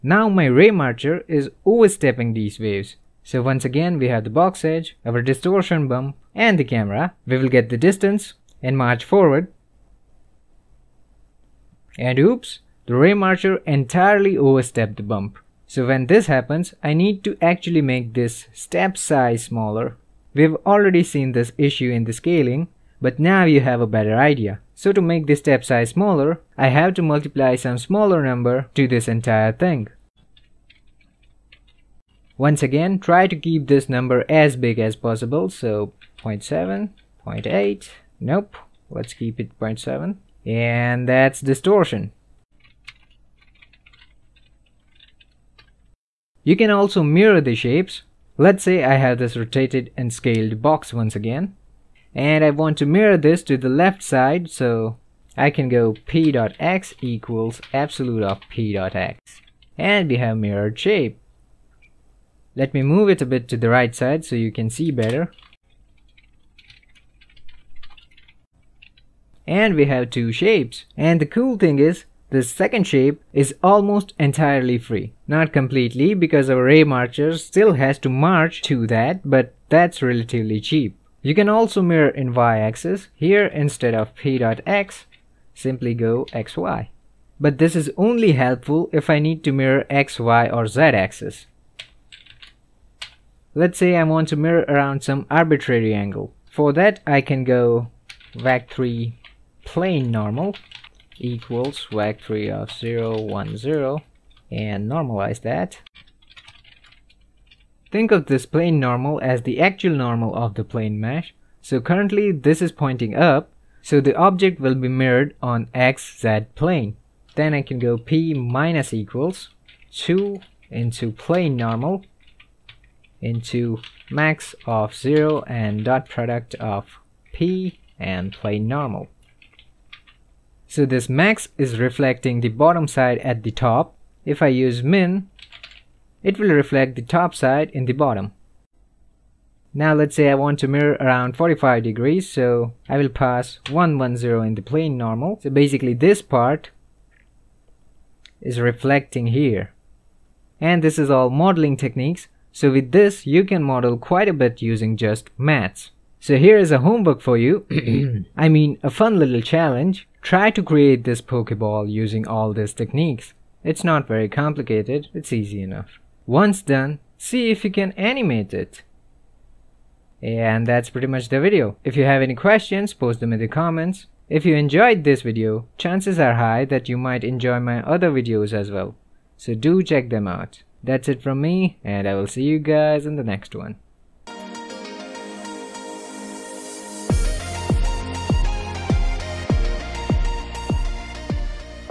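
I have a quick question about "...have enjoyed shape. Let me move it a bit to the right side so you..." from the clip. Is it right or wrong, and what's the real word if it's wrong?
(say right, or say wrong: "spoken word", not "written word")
wrong: "mirrored", not "enjoyed".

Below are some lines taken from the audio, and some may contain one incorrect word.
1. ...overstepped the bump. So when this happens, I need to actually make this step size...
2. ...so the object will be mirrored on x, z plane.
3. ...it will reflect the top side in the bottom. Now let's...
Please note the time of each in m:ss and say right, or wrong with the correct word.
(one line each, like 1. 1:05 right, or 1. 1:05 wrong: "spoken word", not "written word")
1. 0:14 right
2. 1:53 right
3. 2:16 right.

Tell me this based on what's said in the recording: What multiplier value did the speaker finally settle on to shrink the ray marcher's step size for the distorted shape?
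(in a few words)
0.7.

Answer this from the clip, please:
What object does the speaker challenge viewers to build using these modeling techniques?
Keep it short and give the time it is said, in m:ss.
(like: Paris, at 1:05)
Pokeball, at 2:41.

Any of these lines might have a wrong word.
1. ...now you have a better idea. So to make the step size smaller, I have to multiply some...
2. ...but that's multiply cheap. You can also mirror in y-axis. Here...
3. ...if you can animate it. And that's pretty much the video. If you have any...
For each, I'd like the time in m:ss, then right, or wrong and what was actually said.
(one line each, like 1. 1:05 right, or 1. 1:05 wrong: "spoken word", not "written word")
1. 0:23 right
2. 1:19 wrong: "relatively", not "multiply"
3. 2:47 right.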